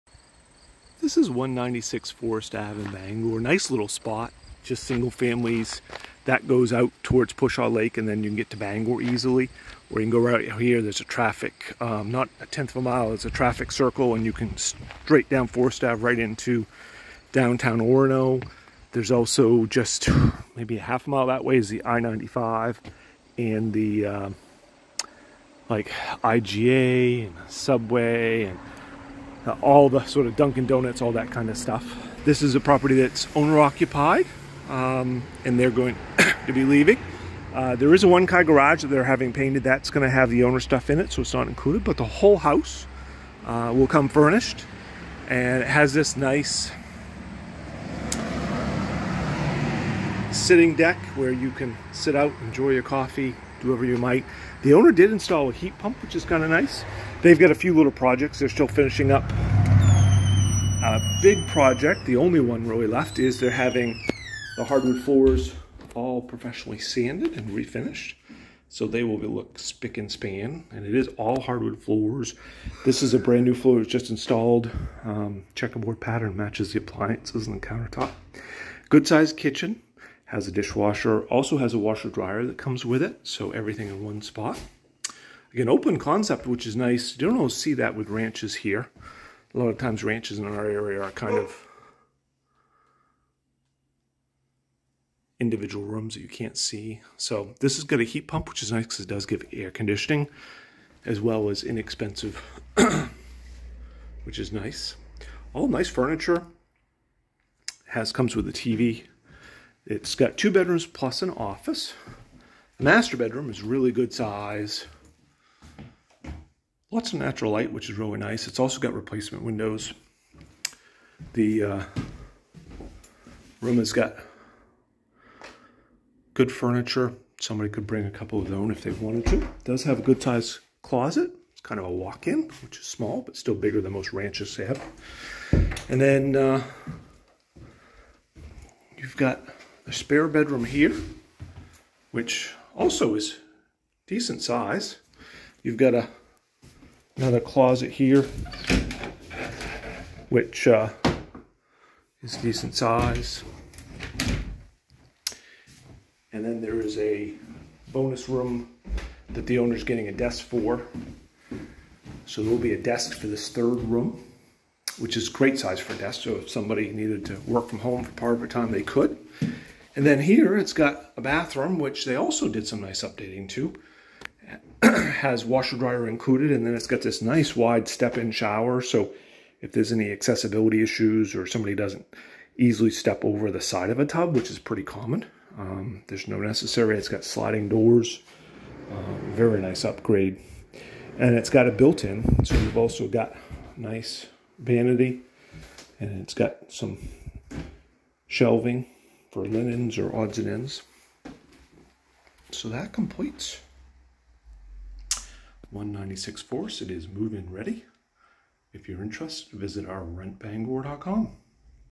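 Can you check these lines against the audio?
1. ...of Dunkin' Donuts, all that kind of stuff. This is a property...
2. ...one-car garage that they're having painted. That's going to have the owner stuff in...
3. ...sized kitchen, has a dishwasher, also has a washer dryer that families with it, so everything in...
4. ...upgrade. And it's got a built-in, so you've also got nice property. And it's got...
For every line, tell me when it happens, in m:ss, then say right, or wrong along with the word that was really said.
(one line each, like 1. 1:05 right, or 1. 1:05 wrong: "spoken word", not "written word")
1. 0:30 right
2. 0:38 right
3. 1:19 wrong: "comes", not "families"
4. 3:09 wrong: "vanity", not "property".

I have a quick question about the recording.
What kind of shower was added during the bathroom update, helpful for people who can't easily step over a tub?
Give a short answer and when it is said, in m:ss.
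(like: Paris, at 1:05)
wide step-in shower, at 2:57.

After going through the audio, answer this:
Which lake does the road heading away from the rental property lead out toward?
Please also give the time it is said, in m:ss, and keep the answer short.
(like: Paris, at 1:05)
Pushaw Lake, at 0:07.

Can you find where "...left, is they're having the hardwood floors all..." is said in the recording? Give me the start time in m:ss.
1:02.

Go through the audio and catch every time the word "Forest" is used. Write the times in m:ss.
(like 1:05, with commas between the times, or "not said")
0:02, 0:15.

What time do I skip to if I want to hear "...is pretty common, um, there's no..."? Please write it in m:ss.
3:04.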